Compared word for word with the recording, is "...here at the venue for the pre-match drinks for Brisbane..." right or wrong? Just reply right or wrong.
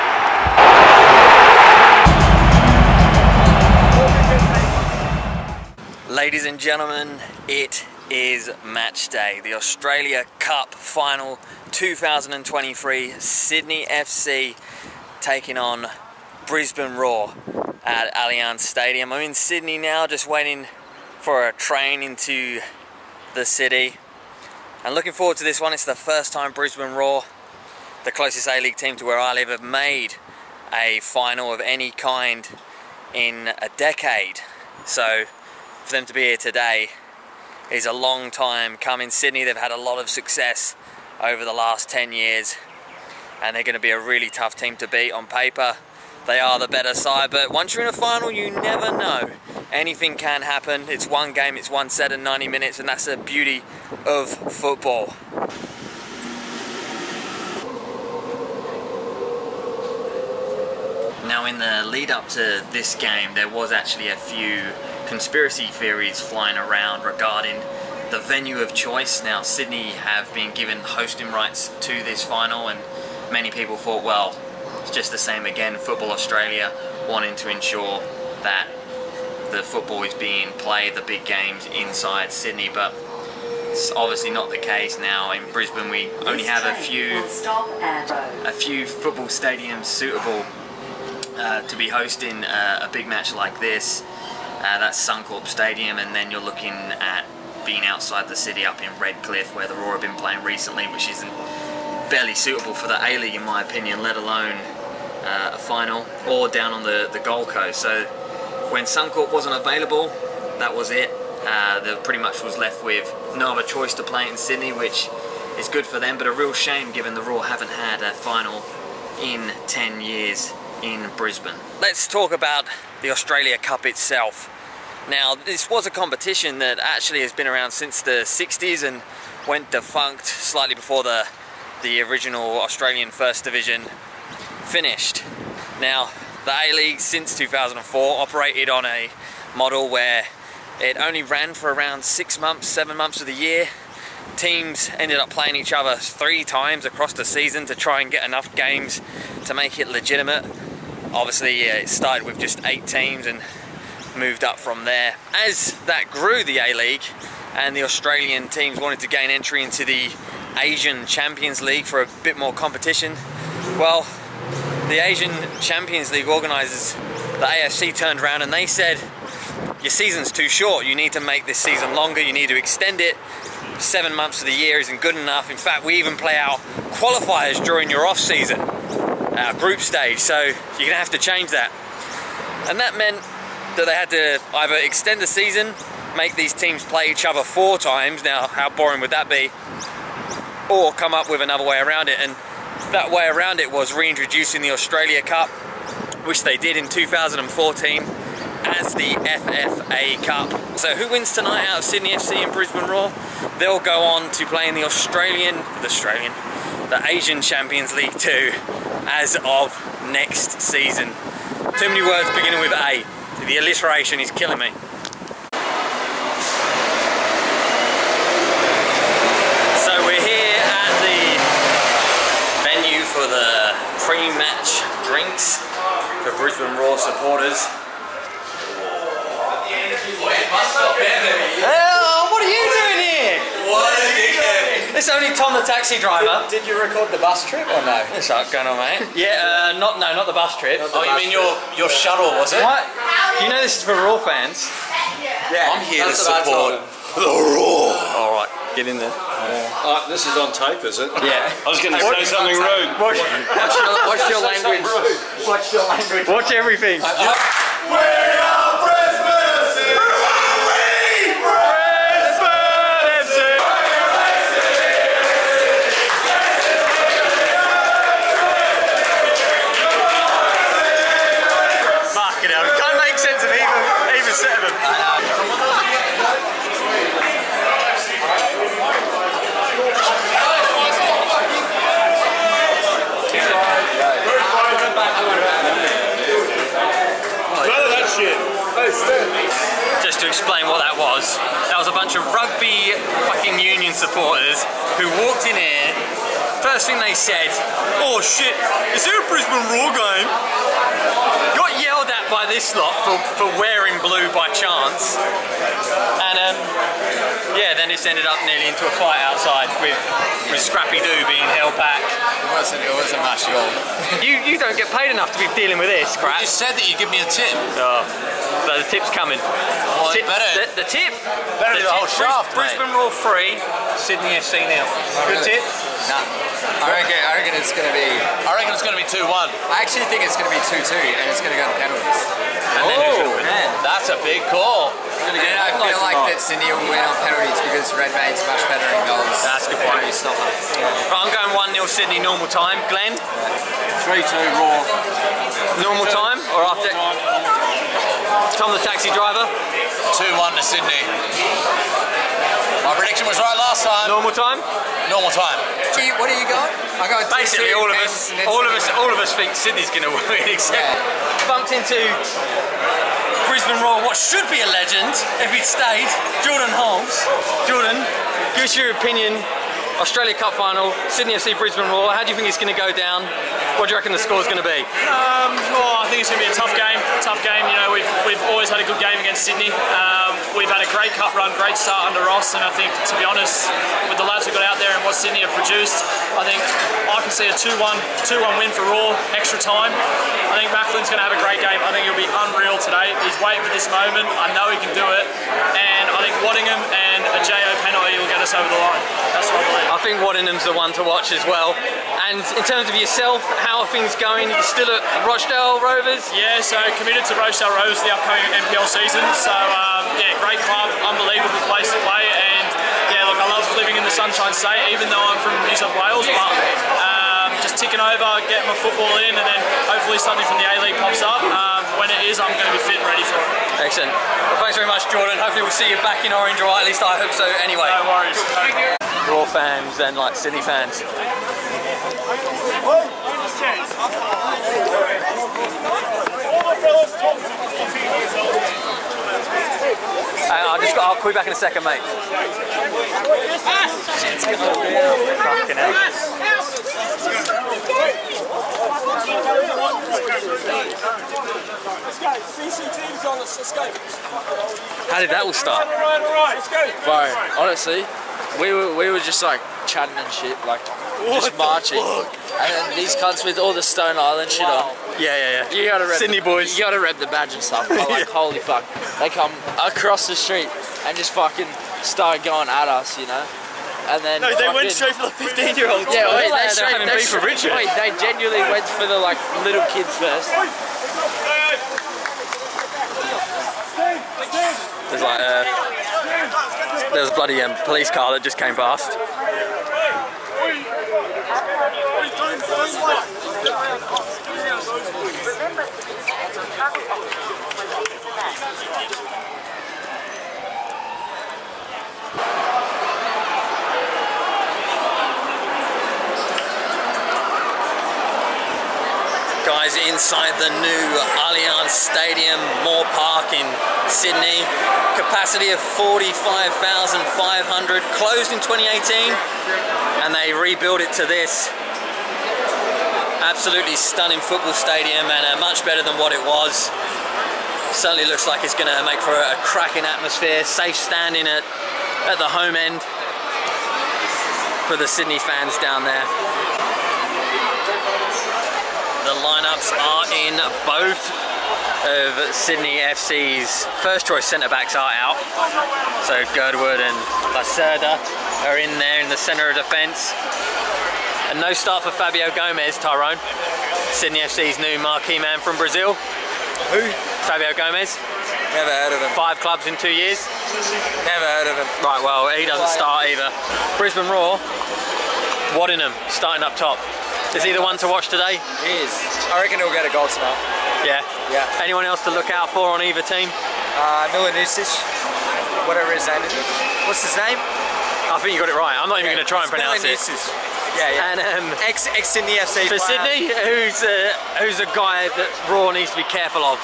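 right.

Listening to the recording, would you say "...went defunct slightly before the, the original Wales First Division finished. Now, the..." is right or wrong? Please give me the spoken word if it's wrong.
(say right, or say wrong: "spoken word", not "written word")
wrong: "Australian", not "Wales".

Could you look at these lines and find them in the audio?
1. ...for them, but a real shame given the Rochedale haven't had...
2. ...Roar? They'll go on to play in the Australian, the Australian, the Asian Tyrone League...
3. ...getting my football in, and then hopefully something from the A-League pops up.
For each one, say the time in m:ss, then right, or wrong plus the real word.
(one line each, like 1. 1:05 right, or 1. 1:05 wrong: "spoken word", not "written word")
1. 1:55 wrong: "Roar", not "Rochedale"
2. 3:22 wrong: "Champions", not "Tyrone"
3. 6:58 right.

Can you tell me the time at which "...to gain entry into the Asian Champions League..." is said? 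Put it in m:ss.
2:38.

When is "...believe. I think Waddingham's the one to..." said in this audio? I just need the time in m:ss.
6:39.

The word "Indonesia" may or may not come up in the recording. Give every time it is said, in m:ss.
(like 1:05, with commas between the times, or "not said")
not said.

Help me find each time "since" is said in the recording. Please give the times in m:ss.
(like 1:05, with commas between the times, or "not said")
2:07, 2:16.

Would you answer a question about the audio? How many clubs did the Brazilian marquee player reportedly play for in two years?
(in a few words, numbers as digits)
5.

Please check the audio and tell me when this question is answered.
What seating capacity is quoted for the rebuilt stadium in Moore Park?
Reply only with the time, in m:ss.
8:35.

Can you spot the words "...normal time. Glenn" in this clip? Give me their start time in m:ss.
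5:42.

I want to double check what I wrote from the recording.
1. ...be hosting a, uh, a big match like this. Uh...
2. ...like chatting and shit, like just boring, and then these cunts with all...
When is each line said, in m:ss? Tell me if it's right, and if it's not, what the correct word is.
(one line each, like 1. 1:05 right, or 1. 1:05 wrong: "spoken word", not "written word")
1. 1:31 right
2. 7:39 wrong: "marching", not "boring".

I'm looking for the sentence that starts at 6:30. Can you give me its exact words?
I think Macklin's going to have a great game.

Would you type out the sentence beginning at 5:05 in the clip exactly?
And um, yeah, then it's ended up nearly into a fight outside with, with Scrappy Doo being held back.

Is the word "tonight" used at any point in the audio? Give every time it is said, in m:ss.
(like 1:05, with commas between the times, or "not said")
3:21, 9:30.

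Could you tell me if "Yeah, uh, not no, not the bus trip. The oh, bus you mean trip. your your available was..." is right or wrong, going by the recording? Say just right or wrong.
wrong.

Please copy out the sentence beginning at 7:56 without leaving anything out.
Yeah, wait, they, straight, they, straight, for Richard.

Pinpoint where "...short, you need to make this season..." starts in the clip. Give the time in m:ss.
2:50.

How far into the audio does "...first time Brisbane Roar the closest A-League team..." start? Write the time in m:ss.
0:25.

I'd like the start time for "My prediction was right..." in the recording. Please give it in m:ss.
5:52.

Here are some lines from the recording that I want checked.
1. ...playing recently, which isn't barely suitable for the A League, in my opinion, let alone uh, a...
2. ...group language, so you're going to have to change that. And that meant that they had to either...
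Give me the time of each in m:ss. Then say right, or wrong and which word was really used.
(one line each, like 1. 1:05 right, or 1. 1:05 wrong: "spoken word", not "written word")
1. 1:40 right
2. 2:59 wrong: "stage", not "language".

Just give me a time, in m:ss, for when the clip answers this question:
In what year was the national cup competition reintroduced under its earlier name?
3:16.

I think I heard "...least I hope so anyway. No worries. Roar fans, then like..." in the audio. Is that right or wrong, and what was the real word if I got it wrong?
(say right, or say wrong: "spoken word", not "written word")
right.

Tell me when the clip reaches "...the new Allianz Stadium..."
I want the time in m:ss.
8:30.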